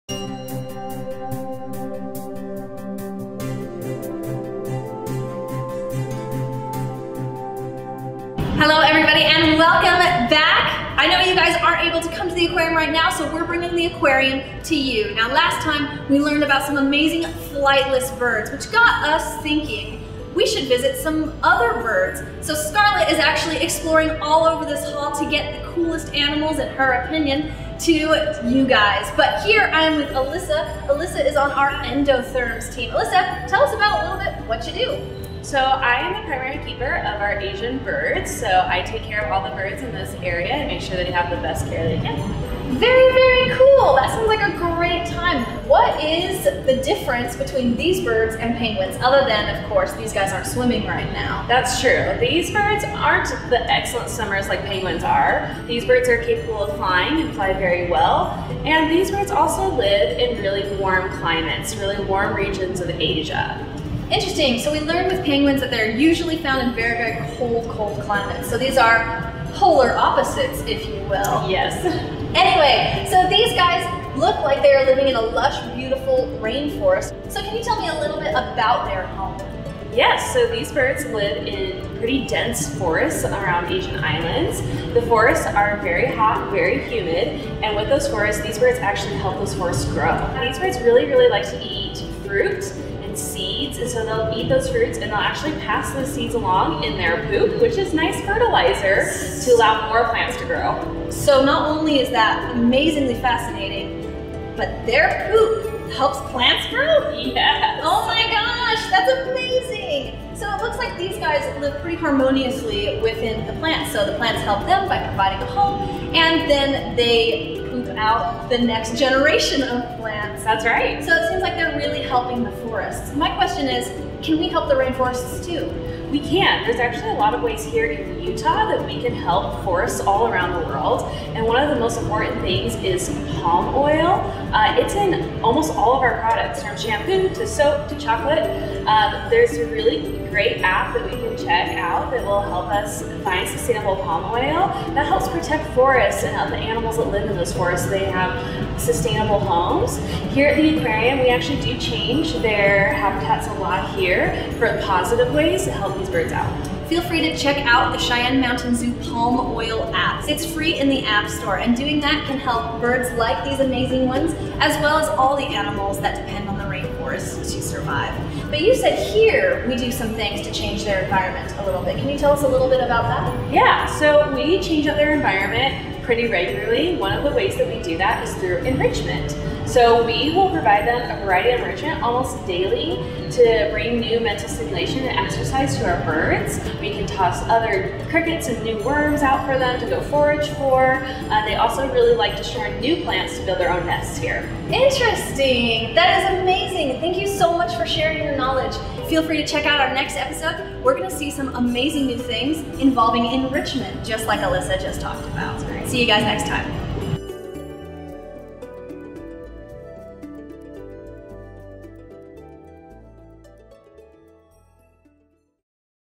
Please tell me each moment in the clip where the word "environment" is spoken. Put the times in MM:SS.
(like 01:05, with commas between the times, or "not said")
02:51, 02:55.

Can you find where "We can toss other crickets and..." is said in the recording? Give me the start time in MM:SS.
03:06.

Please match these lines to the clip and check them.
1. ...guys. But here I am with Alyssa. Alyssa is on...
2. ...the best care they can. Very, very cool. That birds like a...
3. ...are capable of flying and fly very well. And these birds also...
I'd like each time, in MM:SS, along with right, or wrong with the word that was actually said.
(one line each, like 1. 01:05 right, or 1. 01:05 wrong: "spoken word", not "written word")
1. 00:28 right
2. 00:41 wrong: "sounds", not "birds"
3. 00:56 right.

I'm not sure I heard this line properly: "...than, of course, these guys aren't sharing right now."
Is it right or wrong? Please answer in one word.
wrong.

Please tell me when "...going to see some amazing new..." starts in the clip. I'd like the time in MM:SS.
03:20.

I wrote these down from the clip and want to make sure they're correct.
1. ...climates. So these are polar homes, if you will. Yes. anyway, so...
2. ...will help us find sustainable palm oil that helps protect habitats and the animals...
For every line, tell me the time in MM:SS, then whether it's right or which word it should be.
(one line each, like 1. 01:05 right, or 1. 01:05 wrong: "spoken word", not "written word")
1. 01:08 wrong: "opposites", not "homes"
2. 02:22 wrong: "forests", not "habitats".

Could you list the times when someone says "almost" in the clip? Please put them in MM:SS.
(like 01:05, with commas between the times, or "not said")
02:15, 03:02.